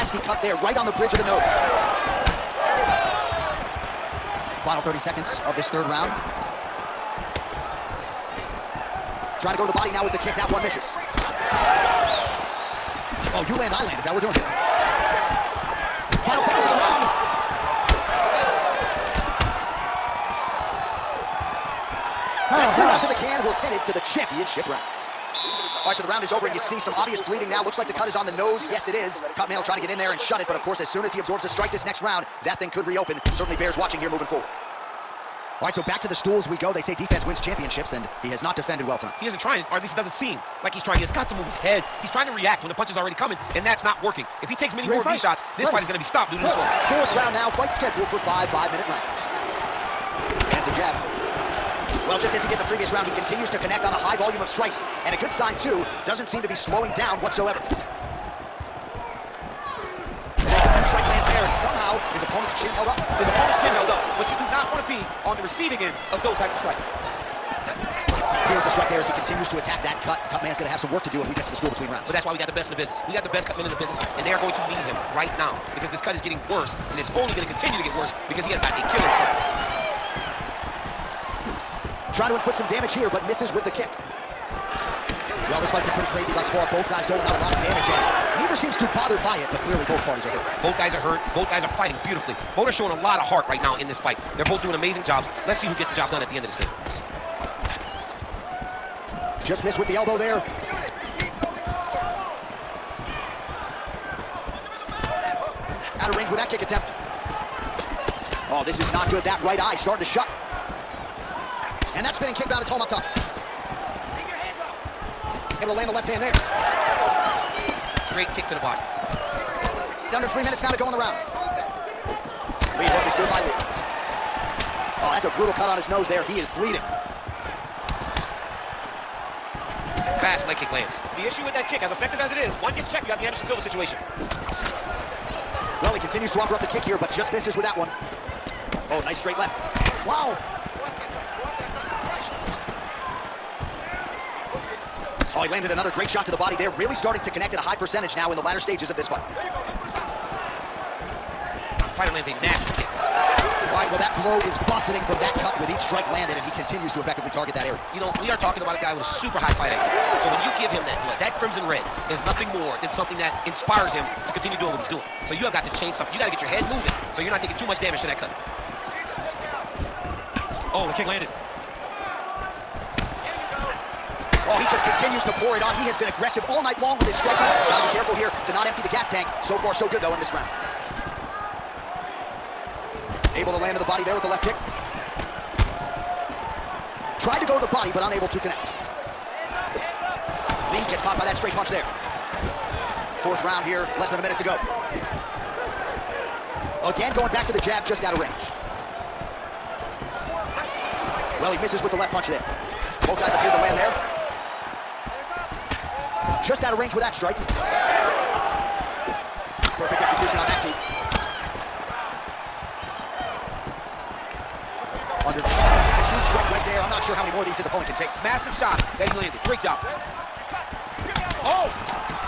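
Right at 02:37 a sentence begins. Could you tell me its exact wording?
You know, we are talking about a guy with a super high fight IQ.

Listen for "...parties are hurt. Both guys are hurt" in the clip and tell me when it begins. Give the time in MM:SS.
01:30.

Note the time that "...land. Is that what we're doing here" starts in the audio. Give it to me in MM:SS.
00:13.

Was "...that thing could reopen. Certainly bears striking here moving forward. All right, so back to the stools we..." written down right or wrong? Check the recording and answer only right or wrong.
wrong.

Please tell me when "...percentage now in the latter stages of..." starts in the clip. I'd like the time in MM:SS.
02:27.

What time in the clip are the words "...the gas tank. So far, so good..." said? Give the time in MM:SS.
02:58.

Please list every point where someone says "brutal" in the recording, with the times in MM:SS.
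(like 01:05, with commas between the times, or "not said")
02:05.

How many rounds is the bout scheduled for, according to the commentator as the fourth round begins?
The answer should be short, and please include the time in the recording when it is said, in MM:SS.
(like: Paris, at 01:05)
5, at 00:48.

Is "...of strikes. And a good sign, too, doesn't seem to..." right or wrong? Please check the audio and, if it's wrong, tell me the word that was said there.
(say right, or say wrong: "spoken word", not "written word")
right.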